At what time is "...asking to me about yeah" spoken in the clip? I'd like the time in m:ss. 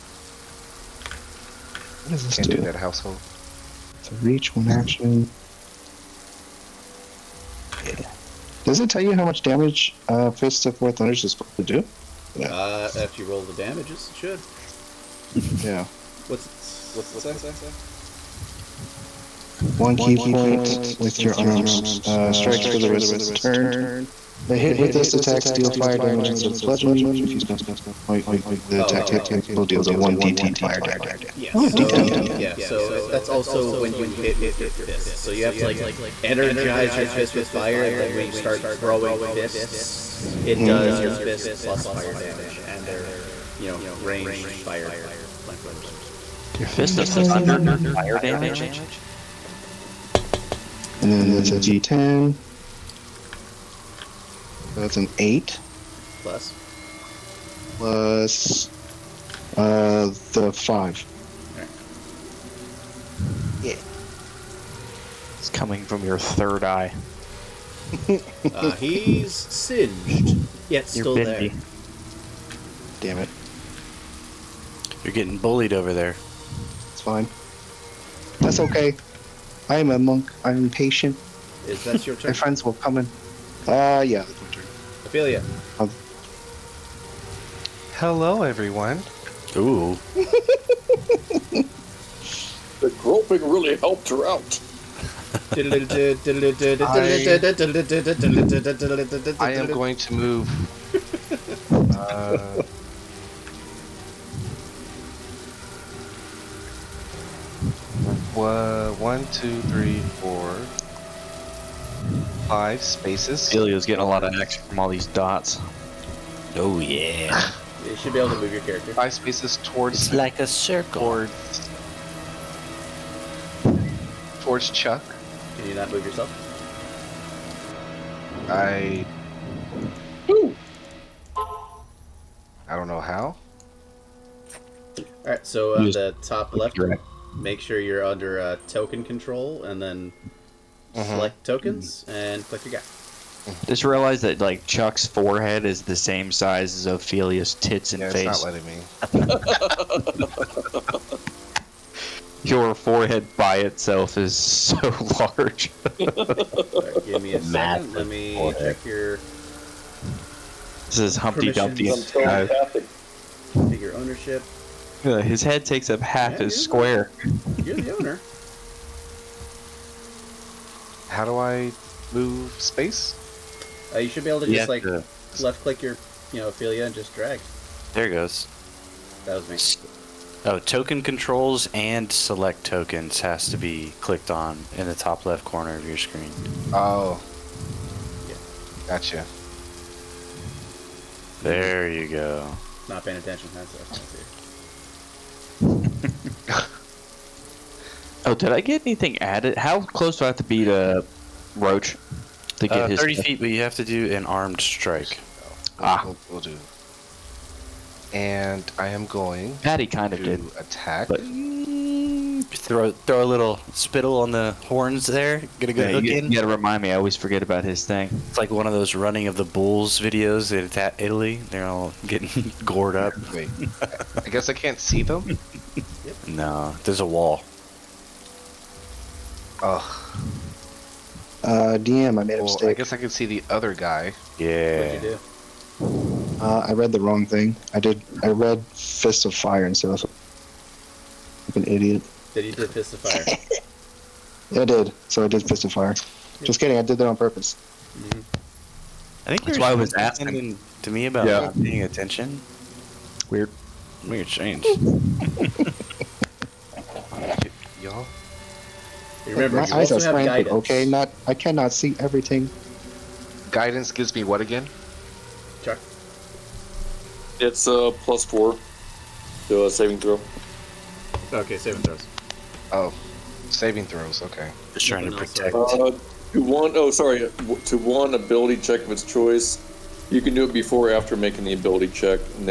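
4:09.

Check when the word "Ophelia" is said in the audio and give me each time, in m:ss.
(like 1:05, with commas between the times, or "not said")
1:25, 2:26, 2:56.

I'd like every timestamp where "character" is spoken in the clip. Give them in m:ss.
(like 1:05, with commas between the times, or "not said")
1:58.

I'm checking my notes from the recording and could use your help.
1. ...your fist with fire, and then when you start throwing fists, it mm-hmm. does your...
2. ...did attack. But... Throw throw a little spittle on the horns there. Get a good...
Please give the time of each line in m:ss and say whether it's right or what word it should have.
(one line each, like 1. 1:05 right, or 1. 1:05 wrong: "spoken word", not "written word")
1. 0:36 right
2. 3:30 right.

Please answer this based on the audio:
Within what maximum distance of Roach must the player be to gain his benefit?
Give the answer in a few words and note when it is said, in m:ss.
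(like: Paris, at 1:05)
30 feet, at 3:22.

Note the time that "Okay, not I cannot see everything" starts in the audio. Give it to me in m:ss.
4:20.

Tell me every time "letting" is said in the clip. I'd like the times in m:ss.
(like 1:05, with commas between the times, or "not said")
2:29.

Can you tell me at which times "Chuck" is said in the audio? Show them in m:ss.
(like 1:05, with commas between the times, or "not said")
2:04, 2:24.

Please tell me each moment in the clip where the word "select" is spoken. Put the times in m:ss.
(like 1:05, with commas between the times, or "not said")
2:21, 3:02.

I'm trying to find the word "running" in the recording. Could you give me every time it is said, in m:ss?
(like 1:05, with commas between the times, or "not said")
3:38.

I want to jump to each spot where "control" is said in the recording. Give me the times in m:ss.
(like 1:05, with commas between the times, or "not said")
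2:19, 3:01.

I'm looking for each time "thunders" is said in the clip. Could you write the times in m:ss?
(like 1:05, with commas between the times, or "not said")
0:10, 0:47.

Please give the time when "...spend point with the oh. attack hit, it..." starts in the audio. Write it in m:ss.
0:27.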